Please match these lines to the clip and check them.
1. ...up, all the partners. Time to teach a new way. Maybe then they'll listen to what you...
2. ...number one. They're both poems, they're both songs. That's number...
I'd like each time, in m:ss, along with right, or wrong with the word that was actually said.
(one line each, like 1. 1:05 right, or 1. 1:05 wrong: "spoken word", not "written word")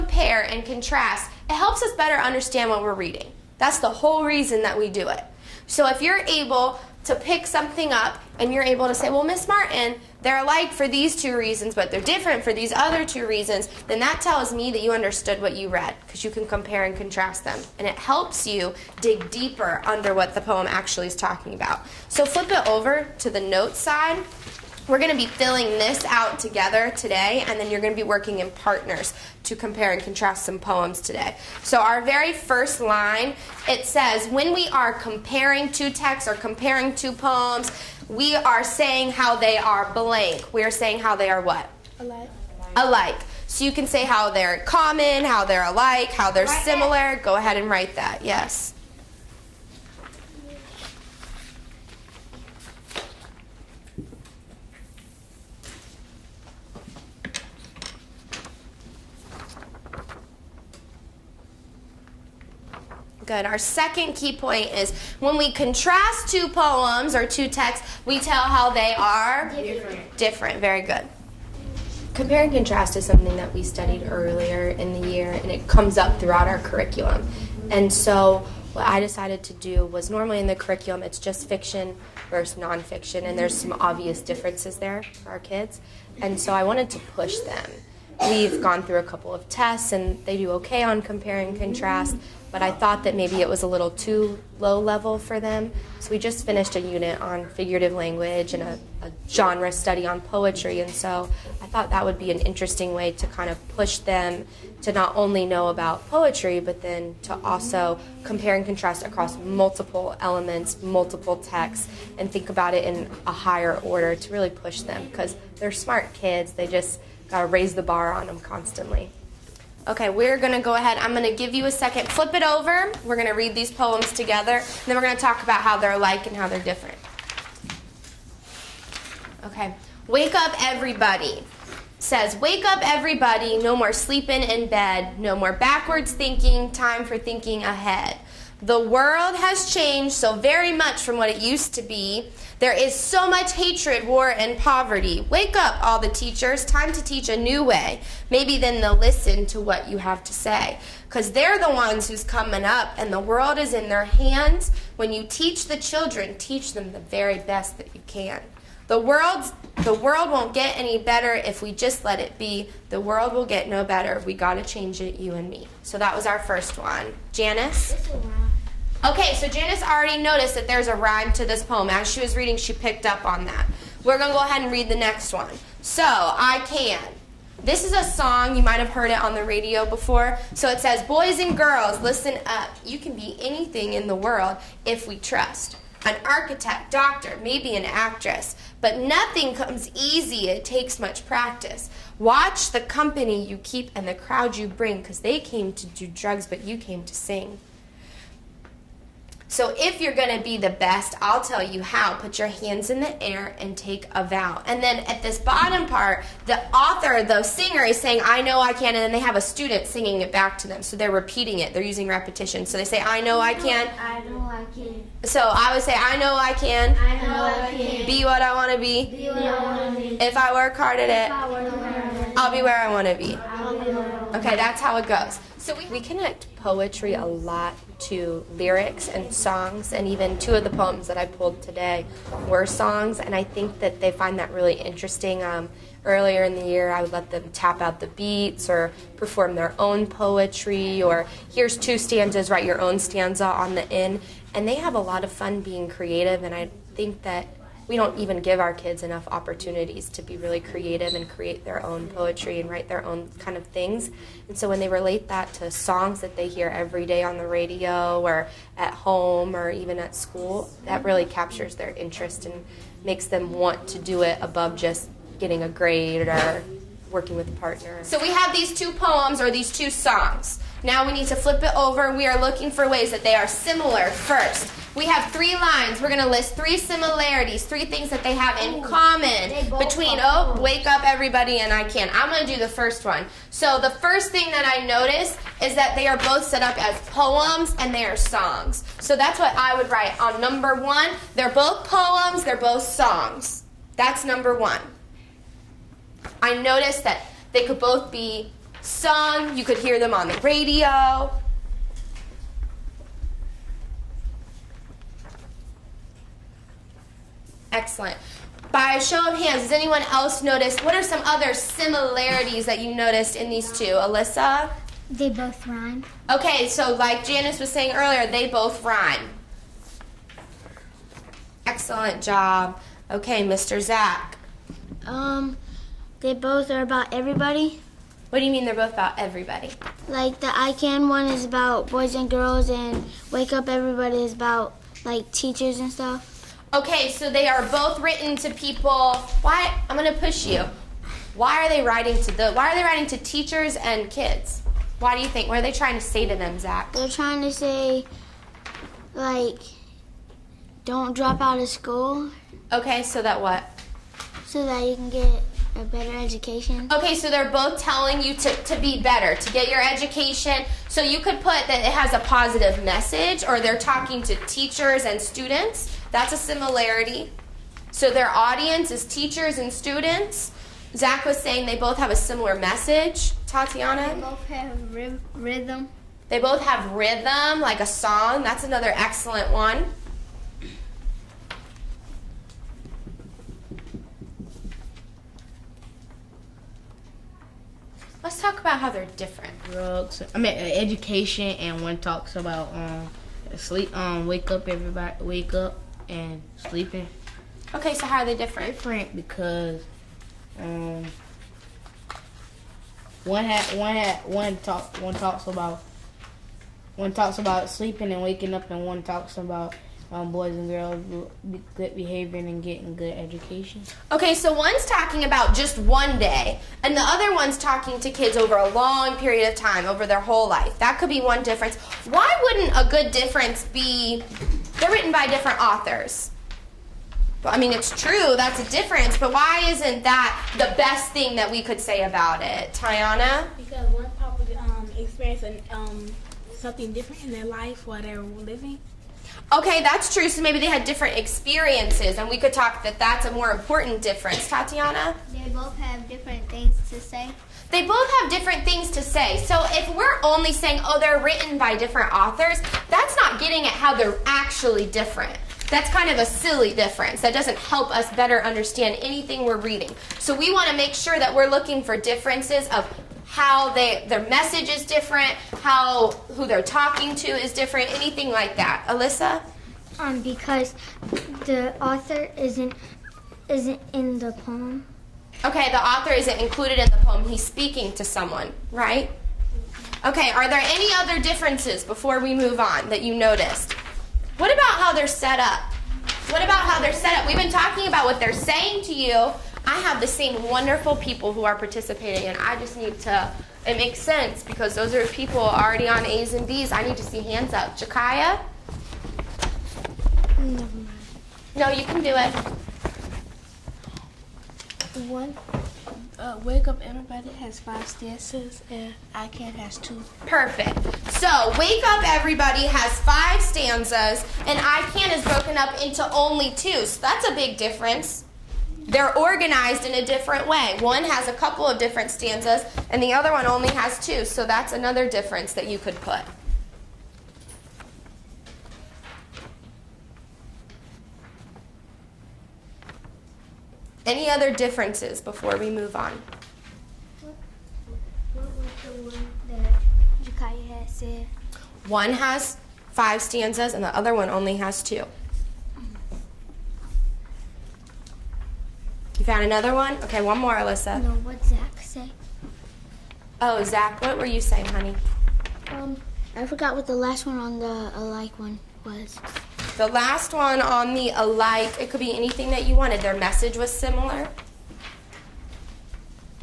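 1. 2:25 wrong: "teachers", not "partners"
2. 4:50 right.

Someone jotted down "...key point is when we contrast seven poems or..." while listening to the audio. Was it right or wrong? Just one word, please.
wrong.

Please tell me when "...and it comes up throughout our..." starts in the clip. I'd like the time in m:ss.
1:15.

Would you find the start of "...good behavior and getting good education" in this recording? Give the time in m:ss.
6:51.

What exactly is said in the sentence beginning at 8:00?
Okay, are there any other differences before we move on that you noticed?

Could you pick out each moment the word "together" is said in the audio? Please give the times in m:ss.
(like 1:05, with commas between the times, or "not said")
0:26, 2:04.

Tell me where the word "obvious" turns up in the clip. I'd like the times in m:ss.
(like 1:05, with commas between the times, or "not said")
1:23.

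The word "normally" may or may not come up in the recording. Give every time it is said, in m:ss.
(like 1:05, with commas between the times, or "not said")
1:20.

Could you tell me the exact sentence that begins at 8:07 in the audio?
We've been talking about what they're saying to you.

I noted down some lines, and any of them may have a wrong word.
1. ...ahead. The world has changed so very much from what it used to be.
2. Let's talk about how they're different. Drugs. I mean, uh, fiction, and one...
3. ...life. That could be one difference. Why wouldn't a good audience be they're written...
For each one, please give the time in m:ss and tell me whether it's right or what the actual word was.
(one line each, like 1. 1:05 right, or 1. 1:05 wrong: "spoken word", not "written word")
1. 2:17 right
2. 6:28 wrong: "education", not "fiction"
3. 7:00 wrong: "difference", not "audience".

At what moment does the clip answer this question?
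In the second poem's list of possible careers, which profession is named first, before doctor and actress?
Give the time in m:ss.
3:06.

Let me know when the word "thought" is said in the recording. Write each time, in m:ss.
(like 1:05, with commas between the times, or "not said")
1:32, 1:41.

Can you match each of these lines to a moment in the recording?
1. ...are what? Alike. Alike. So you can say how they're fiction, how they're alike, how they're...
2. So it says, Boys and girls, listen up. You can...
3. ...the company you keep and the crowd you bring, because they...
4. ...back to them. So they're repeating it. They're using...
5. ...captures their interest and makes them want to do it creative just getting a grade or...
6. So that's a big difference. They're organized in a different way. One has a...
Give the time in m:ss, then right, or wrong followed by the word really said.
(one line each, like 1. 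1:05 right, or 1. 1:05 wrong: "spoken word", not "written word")
1. 0:41 wrong: "common", not "fiction"
2. 3:00 right
3. 3:12 right
4. 3:30 right
5. 4:21 wrong: "above", not "creative"
6. 8:36 right.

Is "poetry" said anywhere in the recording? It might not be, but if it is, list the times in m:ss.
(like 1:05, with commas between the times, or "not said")
1:40, 1:46, 3:46, 4:00, 4:12.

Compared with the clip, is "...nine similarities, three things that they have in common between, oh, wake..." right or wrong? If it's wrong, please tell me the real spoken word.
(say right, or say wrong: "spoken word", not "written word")
wrong: "three", not "nine".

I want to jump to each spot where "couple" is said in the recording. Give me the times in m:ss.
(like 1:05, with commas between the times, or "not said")
1:29, 8:41.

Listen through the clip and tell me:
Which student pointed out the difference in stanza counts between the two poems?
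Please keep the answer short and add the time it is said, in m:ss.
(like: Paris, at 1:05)
Jakaya, at 8:17.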